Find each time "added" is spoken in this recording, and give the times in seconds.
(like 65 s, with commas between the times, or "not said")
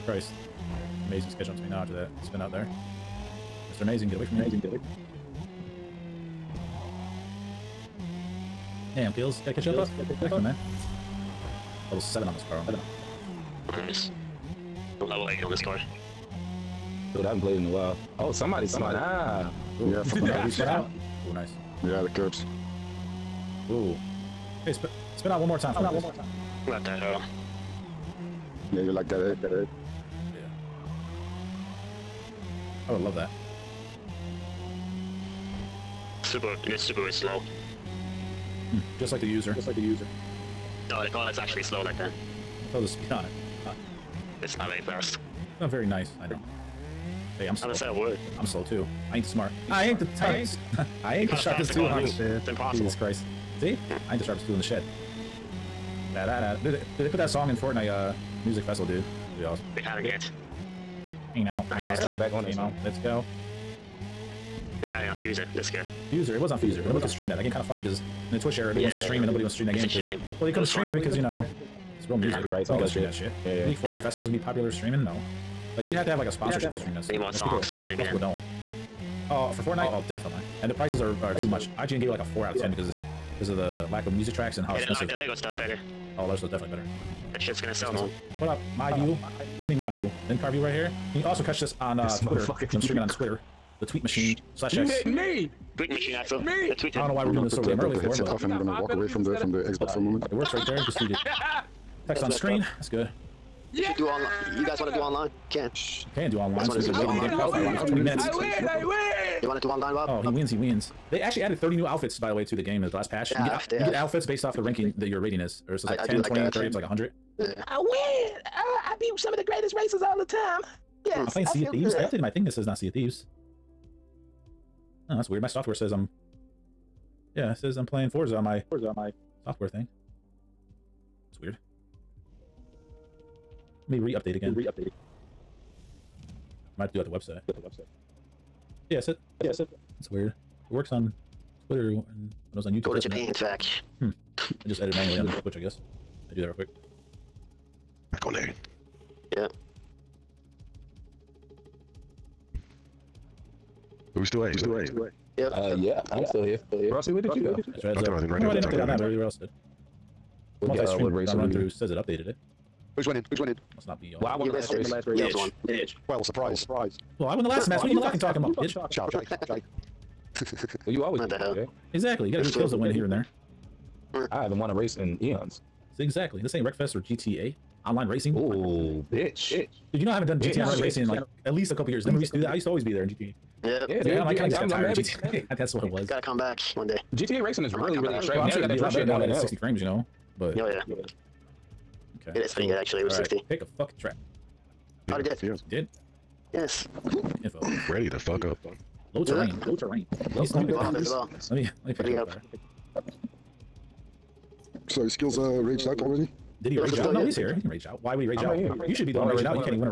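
111 s.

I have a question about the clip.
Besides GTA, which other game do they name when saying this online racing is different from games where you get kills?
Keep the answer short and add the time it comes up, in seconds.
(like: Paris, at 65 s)
Wreckfest, at 176 s.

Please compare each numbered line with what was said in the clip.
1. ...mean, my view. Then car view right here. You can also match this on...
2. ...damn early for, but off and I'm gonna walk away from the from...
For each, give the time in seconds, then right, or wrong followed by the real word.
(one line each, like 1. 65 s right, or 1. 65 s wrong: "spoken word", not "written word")
1. 89 s wrong: "catch", not "match"
2. 97 s right.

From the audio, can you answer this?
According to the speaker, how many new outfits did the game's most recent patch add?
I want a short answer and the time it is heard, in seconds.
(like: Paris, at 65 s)
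30, at 111 s.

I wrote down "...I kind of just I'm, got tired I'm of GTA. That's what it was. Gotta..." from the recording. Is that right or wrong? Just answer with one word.
right.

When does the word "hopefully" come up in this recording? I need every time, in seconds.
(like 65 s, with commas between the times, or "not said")
not said.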